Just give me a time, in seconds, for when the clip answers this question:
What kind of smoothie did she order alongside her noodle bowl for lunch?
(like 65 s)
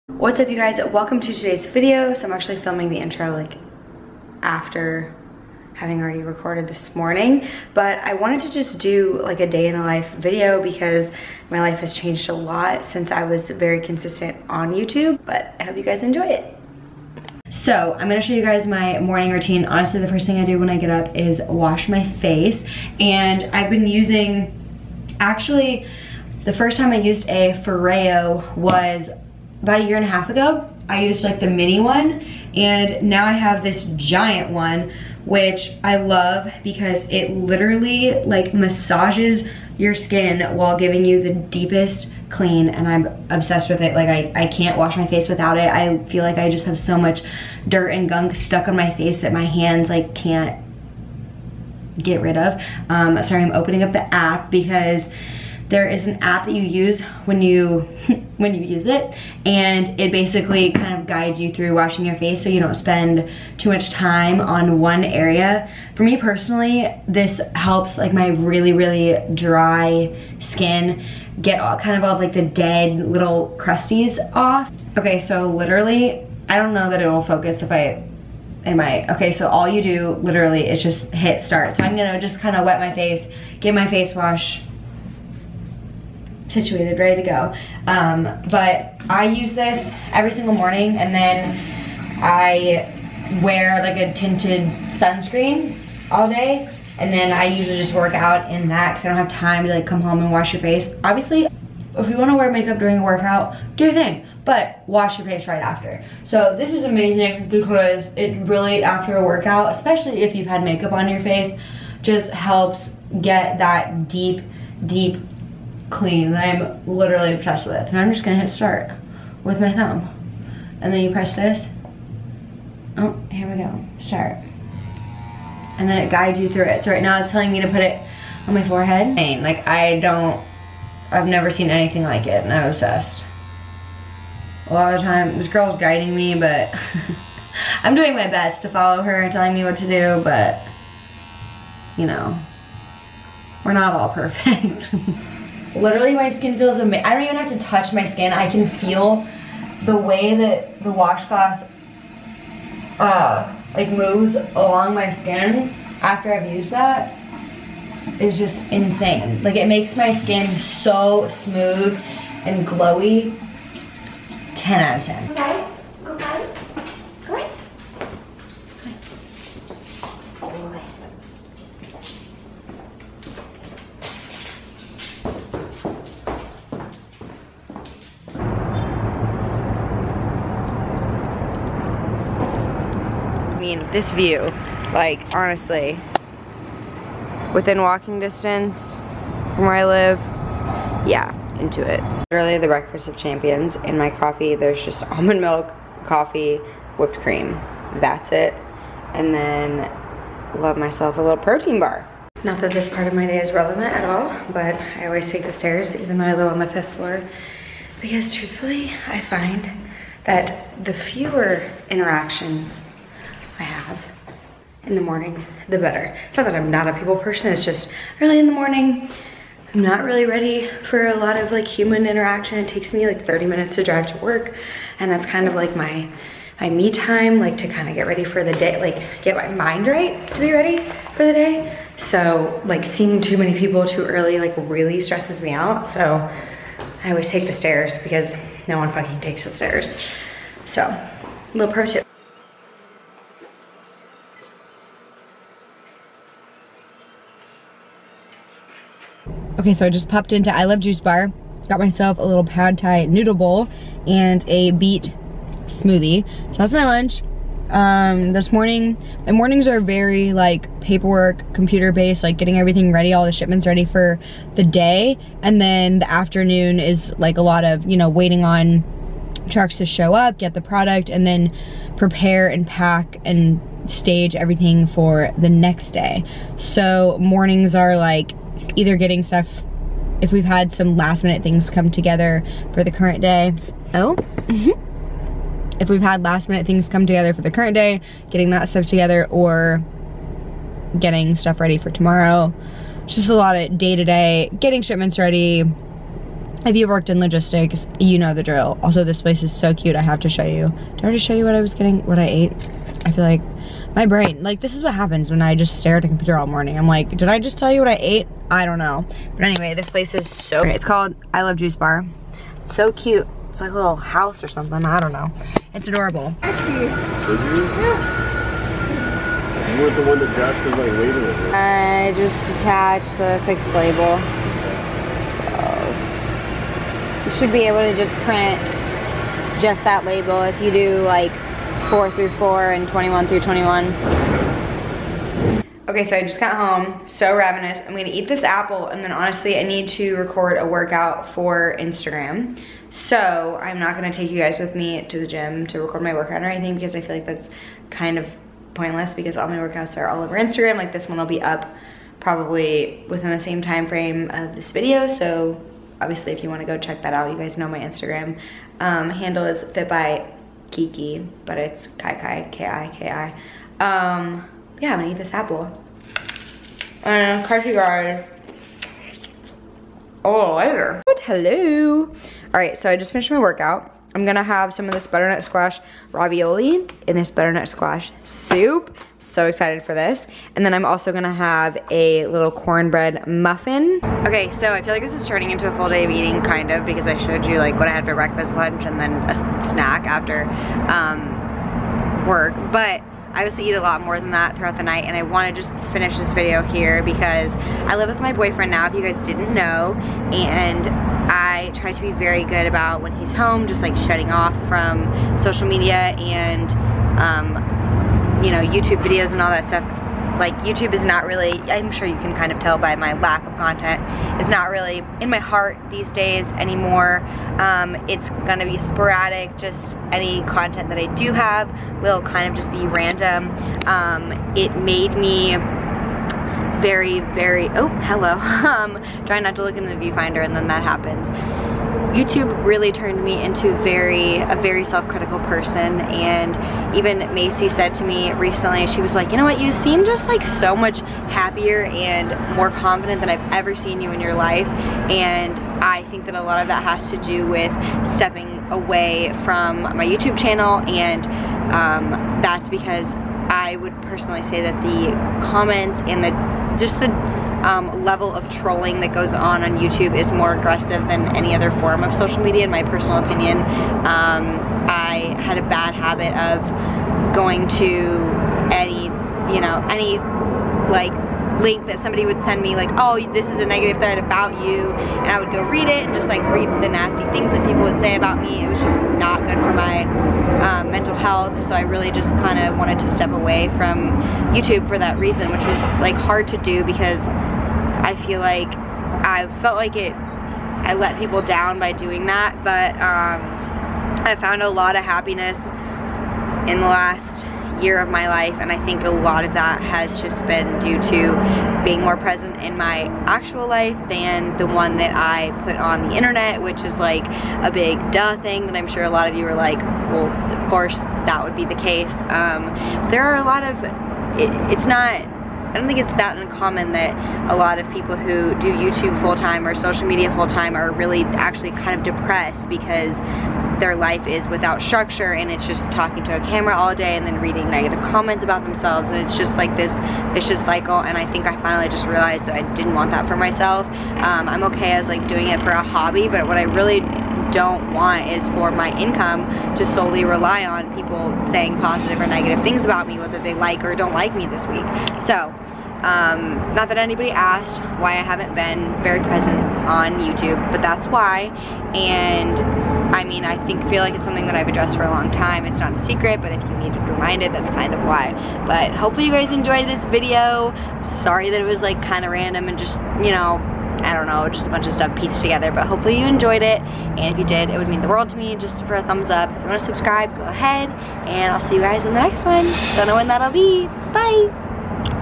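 254 s.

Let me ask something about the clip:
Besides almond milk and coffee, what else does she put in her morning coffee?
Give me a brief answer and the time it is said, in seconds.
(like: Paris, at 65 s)
whipped cream, at 196 s.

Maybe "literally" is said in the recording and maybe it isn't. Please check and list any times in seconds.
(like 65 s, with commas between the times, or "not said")
37 s, 75 s, 80 s, 116 s, 145 s.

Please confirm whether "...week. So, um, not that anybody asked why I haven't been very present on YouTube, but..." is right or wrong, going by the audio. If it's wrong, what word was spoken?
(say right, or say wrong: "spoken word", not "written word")
right.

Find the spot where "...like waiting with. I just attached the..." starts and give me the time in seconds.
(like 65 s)
320 s.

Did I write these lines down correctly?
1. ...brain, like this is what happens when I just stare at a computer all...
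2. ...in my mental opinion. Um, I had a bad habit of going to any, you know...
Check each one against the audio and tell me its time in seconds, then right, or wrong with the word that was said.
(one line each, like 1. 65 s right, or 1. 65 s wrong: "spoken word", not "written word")
1. 304 s right
2. 462 s wrong: "personal", not "mental".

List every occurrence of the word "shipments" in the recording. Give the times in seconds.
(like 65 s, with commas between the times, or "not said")
263 s, 294 s.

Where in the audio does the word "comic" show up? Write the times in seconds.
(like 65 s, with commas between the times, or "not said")
not said.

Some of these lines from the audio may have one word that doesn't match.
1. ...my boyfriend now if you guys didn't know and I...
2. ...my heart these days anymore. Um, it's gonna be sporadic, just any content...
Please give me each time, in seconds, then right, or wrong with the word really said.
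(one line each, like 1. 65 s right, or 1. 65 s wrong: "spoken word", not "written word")
1. 398 s right
2. 415 s right.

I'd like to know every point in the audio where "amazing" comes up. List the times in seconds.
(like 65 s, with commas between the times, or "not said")
106 s, 146 s.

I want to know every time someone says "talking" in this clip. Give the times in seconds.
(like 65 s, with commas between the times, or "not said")
525 s.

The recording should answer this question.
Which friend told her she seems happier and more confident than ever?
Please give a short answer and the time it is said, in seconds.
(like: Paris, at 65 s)
Macy, at 437 s.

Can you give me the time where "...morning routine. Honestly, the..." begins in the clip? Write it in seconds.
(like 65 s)
18 s.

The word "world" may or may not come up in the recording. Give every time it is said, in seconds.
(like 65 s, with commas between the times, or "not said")
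568 s.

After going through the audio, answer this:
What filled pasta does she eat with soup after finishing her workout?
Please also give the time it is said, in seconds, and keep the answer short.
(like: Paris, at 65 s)
butternut squash ravioli, at 375 s.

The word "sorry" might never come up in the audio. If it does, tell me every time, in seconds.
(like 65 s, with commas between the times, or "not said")
53 s, 561 s.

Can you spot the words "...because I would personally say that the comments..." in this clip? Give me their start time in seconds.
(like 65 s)
452 s.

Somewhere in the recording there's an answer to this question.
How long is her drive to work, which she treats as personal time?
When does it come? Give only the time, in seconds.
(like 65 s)
223 s.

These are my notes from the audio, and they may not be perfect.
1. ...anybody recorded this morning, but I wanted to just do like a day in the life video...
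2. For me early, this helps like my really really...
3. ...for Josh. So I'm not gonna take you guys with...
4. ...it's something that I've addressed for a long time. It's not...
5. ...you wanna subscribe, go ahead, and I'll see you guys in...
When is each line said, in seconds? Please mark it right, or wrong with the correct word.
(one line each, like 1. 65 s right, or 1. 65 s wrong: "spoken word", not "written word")
1. 5 s wrong: "already", not "anybody"
2. 65 s wrong: "personally", not "early"
3. 341 s wrong: "Instagram", not "Josh"
4. 554 s right
5. 569 s right.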